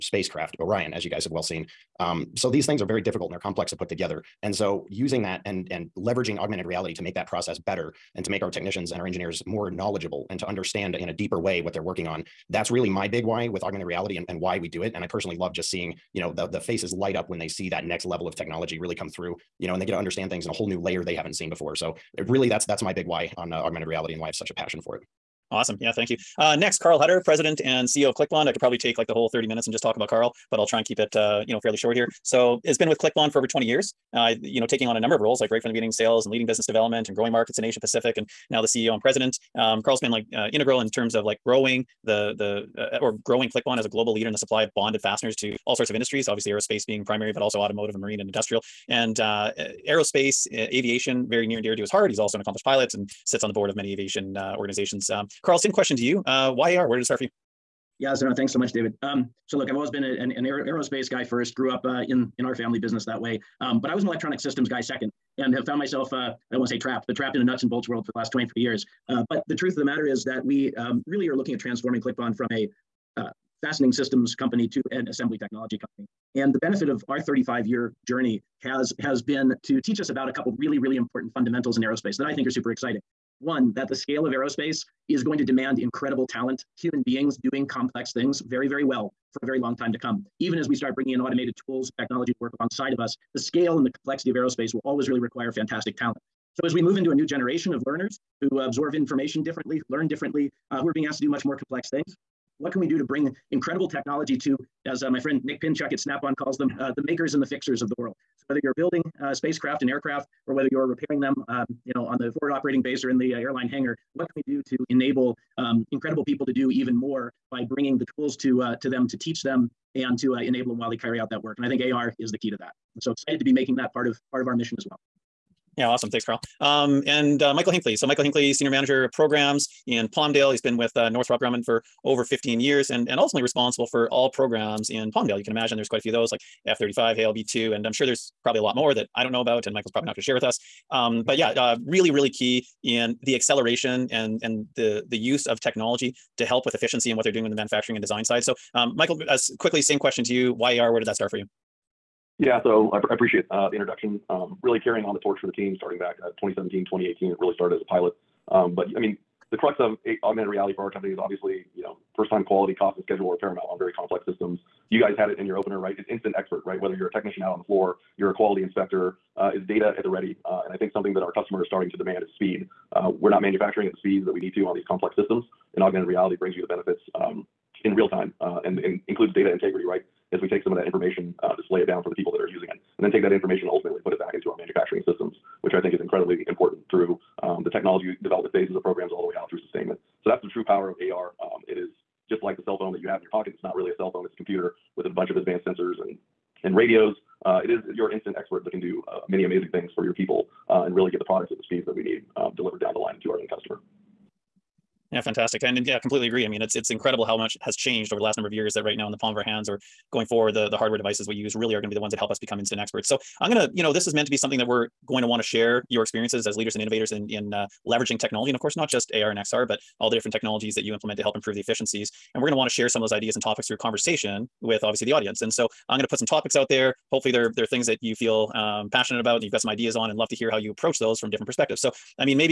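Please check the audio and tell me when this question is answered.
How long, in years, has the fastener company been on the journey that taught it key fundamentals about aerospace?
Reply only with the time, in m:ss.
1:17.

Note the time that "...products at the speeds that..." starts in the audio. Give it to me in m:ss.
3:21.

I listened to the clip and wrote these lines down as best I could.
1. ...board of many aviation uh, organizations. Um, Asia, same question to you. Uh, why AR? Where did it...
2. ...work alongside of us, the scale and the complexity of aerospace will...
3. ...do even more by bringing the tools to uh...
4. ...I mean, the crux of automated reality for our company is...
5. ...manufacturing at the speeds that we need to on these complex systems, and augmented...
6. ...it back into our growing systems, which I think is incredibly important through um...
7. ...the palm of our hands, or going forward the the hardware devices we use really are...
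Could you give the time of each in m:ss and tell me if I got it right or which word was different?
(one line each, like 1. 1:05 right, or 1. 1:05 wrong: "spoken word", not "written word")
1. 0:53 wrong: "Karl", not "Asia"
2. 1:32 right
3. 1:56 right
4. 2:38 wrong: "augmented", not "automated"
5. 2:53 right
6. 3:04 wrong: "manufacturing", not "growing"
7. 3:29 right.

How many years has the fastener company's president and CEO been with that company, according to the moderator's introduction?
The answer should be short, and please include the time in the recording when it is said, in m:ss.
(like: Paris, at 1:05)
over 20 years, at 0:33.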